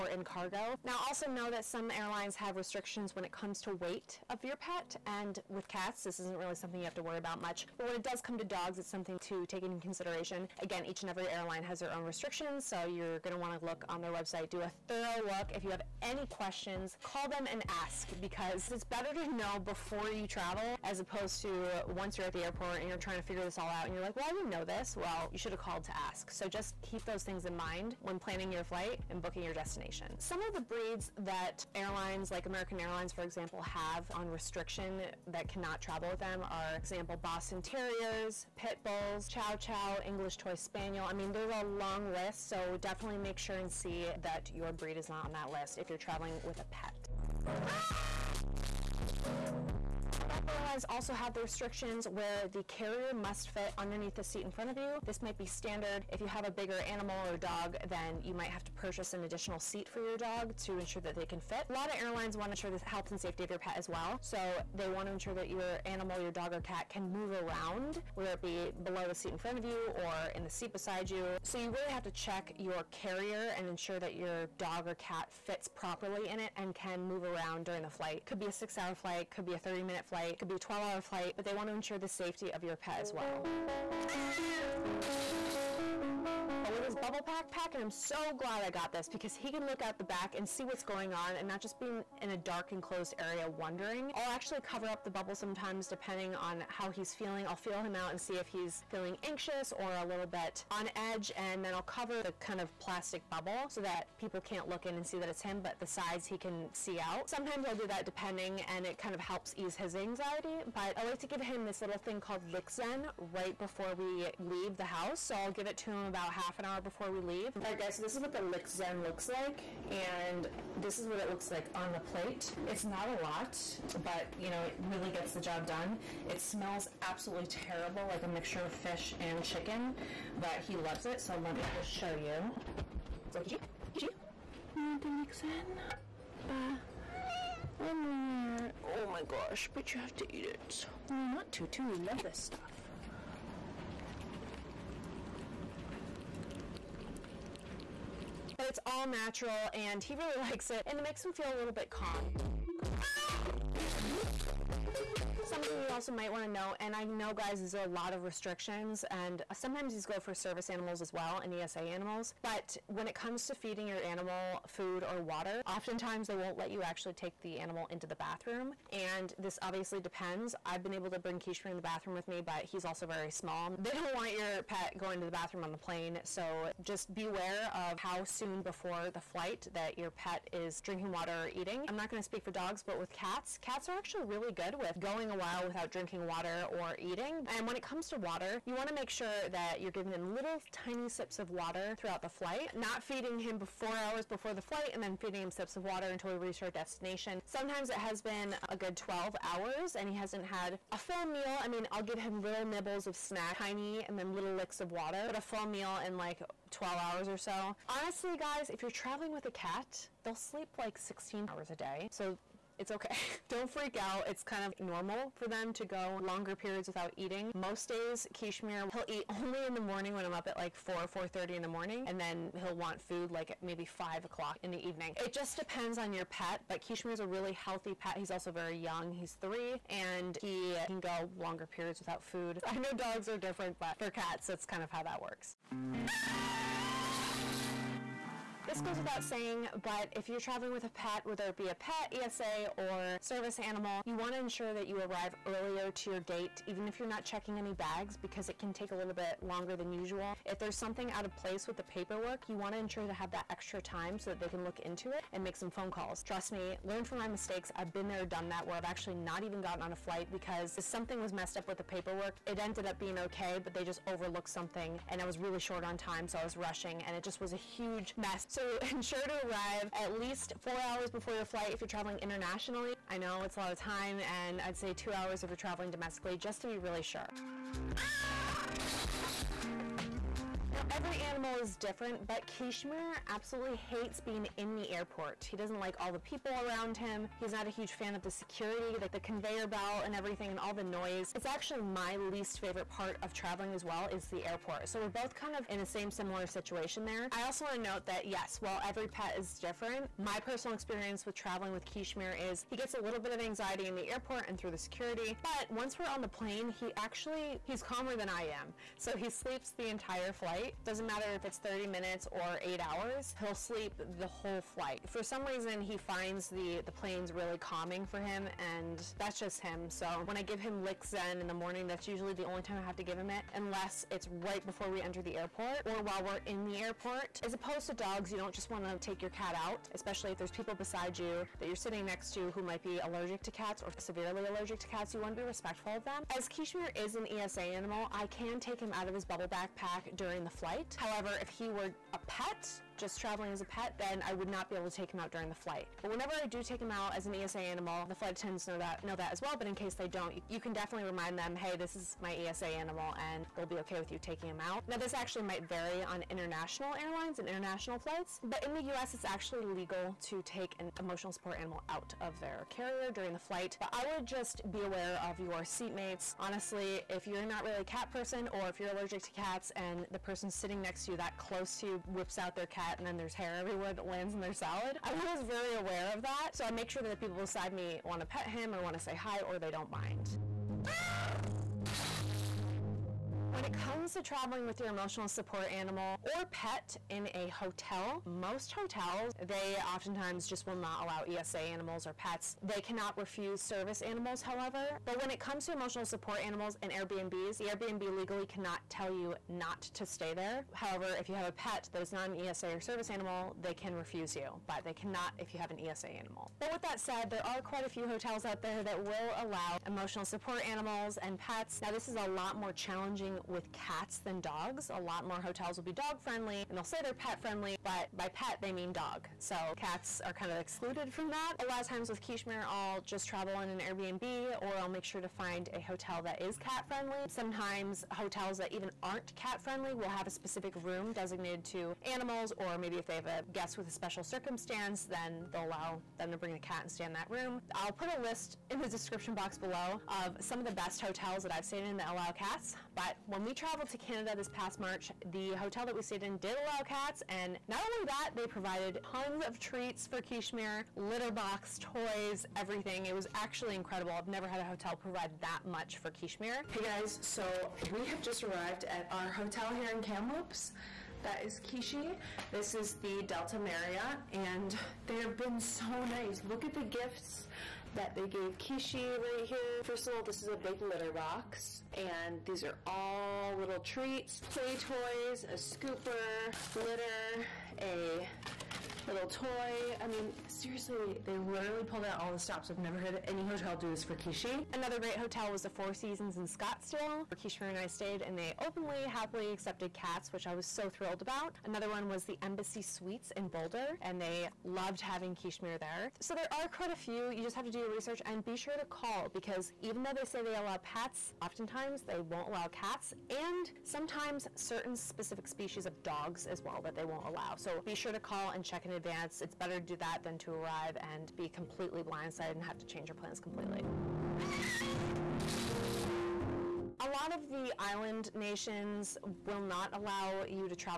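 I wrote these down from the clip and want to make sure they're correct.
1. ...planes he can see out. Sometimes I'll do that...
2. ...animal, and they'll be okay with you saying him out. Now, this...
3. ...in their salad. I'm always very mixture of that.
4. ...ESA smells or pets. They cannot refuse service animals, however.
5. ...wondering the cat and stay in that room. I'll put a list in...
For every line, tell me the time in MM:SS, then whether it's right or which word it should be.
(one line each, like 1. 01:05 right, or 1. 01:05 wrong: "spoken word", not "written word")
1. 01:45 wrong: "sides", not "planes"
2. 05:52 wrong: "taking", not "saying"
3. 06:14 wrong: "aware", not "mixture"
4. 06:31 wrong: "animals", not "smells"
5. 07:16 wrong: "bring", not "wondering".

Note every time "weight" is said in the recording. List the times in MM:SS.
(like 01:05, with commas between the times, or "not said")
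00:03.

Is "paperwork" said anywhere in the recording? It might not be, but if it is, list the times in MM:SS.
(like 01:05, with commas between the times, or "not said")
04:11, 04:21.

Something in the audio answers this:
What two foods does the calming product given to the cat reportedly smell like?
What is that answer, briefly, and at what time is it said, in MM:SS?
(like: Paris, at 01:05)
fish and chicken, at 02:08.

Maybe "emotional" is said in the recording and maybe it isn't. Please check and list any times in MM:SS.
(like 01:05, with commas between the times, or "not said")
06:00, 06:24, 06:35, 06:49.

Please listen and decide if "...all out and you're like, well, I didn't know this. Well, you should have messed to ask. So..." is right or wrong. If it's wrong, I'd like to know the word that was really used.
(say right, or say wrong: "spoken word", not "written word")
wrong: "called", not "messed".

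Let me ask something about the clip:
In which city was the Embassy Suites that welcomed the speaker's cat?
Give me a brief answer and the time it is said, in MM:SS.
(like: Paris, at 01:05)
Boulder, at 08:13.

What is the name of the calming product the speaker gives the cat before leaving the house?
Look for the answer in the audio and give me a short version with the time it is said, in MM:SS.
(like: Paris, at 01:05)
Licks Zen, at 01:52.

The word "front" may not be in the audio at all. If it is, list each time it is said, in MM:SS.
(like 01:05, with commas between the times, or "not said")
00:54, 01:09.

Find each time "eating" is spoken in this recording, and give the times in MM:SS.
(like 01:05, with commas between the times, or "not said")
03:01, 03:07, 03:37.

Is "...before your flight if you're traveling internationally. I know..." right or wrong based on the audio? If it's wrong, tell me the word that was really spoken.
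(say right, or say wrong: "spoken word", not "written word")
right.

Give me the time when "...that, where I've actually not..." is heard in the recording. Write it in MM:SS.
04:18.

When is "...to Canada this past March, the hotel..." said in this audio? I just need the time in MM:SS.
07:23.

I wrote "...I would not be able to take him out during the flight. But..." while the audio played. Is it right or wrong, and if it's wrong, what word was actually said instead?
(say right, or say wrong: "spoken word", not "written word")
right.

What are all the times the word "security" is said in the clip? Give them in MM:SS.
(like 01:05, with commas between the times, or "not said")
04:48, 05:04.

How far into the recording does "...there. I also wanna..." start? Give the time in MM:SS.
04:57.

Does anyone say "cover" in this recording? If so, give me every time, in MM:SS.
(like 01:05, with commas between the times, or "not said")
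01:34, 01:41.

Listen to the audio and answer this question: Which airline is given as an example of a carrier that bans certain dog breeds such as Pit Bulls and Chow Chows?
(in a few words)
American Airlines.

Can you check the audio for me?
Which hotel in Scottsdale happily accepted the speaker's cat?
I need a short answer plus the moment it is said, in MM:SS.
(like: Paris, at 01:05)
Four Seasons, at 08:05.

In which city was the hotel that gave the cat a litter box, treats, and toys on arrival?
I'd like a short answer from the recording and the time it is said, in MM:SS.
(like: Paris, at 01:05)
Kamloops, at 07:40.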